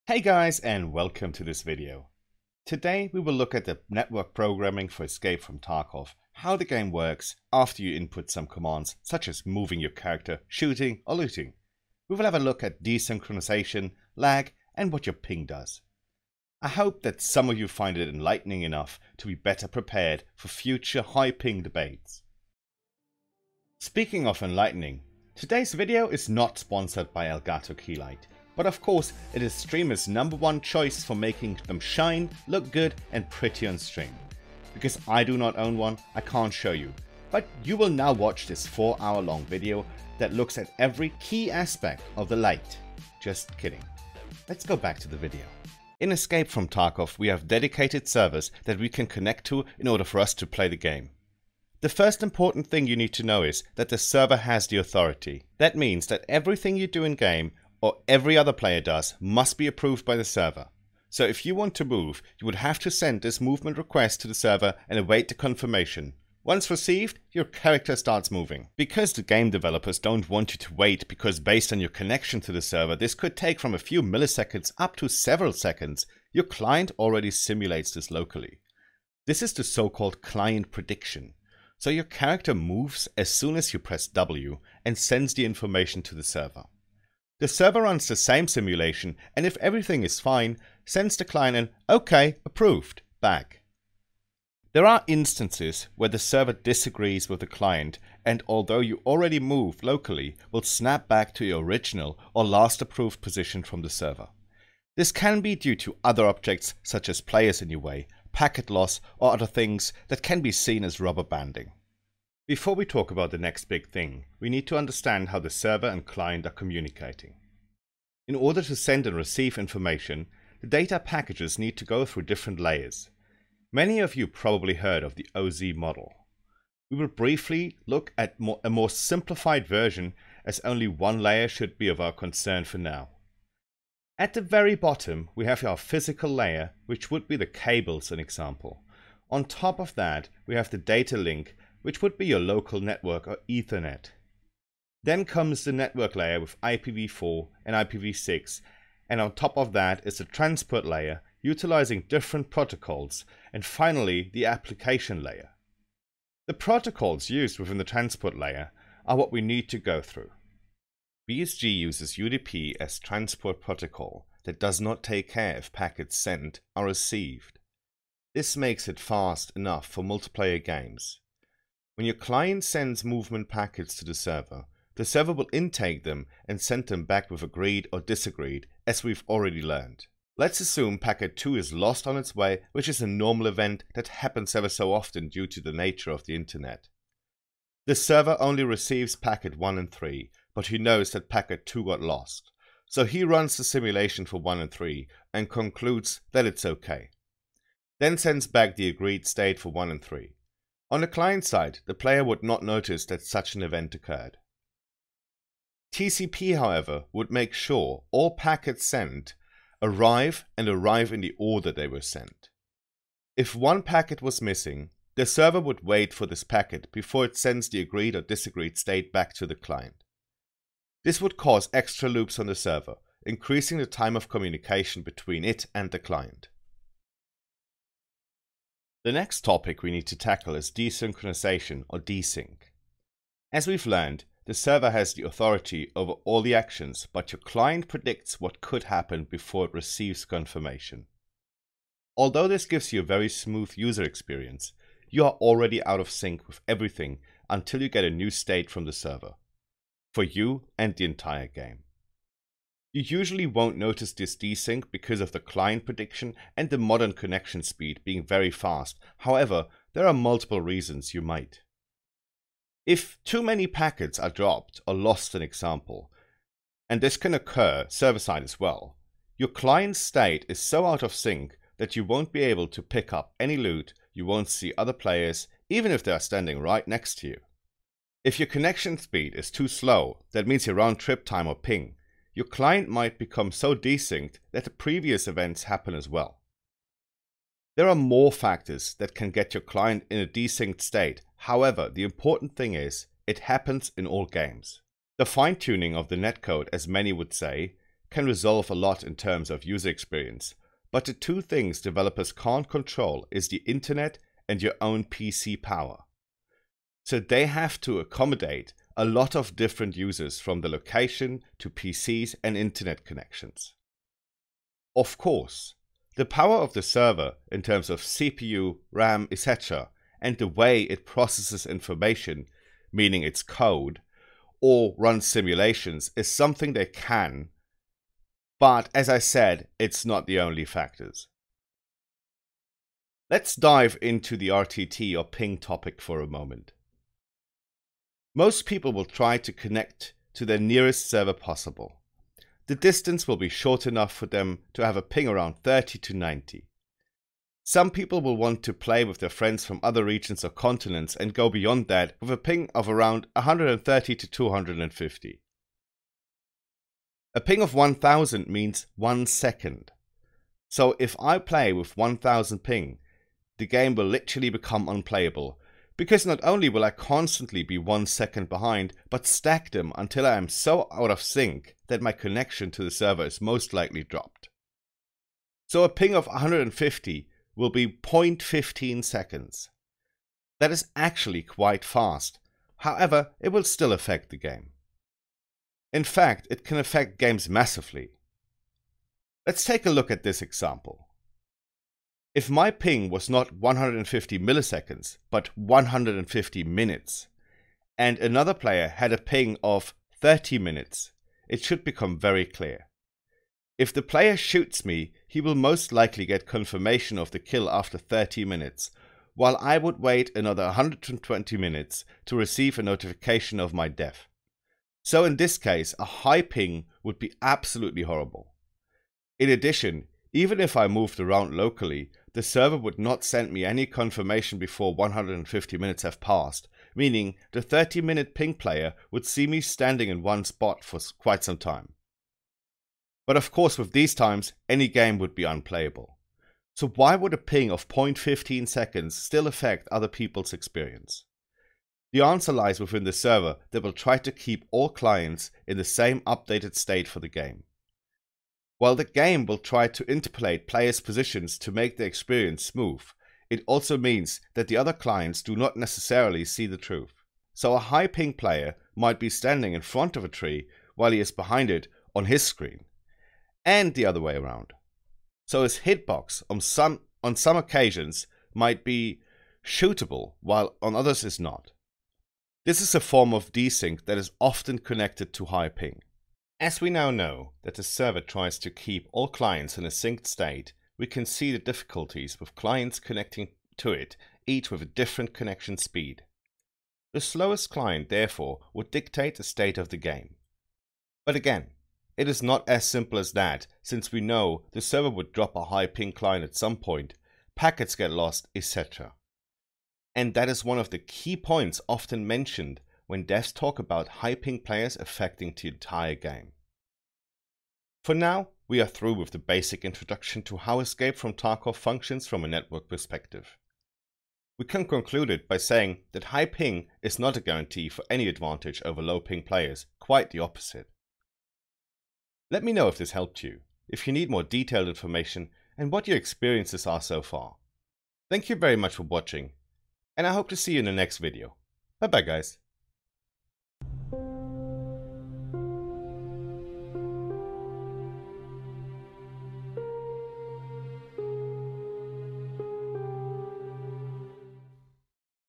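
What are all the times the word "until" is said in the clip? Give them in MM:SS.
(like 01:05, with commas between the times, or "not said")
04:07, 06:09.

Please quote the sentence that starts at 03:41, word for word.
This would cause extra loops on the server, increasing the time of communication between it and the client.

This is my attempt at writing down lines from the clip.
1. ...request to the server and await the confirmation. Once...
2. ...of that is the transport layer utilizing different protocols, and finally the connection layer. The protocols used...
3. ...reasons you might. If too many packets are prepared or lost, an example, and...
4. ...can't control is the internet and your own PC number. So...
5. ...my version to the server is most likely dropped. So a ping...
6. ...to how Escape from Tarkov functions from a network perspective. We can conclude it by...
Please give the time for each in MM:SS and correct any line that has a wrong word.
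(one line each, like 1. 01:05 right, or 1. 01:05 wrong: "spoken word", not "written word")
1. 01:03 right
2. 02:29 wrong: "application", not "connection"
3. 04:20 wrong: "dropped", not "prepared"
4. 05:02 wrong: "power", not "number"
5. 06:12 wrong: "connection", not "version"
6. 08:30 right.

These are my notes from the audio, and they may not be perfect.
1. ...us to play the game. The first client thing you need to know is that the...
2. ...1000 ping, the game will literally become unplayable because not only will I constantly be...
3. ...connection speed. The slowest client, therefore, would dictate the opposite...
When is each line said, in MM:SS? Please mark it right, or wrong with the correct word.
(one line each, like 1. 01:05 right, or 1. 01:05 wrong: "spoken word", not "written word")
1. 00:50 wrong: "important", not "client"
2. 06:01 right
3. 08:05 wrong: "state", not "opposite".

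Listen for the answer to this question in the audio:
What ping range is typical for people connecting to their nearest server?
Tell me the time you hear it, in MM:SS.
05:45.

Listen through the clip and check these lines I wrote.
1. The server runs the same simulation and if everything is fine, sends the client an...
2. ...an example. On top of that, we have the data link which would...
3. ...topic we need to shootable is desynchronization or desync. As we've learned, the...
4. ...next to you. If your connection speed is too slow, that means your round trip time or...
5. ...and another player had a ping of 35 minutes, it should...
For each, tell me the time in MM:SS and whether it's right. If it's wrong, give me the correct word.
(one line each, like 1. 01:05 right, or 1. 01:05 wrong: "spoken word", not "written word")
1. 01:27 right
2. 02:18 right
3. 03:49 wrong: "tackle", not "shootable"
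4. 04:36 right
5. 06:37 wrong: "30", not "35".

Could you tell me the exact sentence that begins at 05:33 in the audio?
Let's dive into the RTT or ping topic for a moment.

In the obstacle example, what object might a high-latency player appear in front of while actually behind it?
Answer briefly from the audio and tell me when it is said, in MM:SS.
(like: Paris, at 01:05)
a tree, at 07:40.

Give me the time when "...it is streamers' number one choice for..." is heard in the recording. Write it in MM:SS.
00:29.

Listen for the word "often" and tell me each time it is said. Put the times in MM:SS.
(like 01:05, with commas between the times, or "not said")
03:04, 07:54, 08:21.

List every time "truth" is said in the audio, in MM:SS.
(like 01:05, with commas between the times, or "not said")
07:36.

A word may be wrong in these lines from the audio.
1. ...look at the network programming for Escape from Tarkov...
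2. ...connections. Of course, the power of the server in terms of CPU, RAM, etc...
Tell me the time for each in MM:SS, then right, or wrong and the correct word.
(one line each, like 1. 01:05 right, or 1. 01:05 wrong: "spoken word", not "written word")
1. 00:03 right
2. 05:13 right.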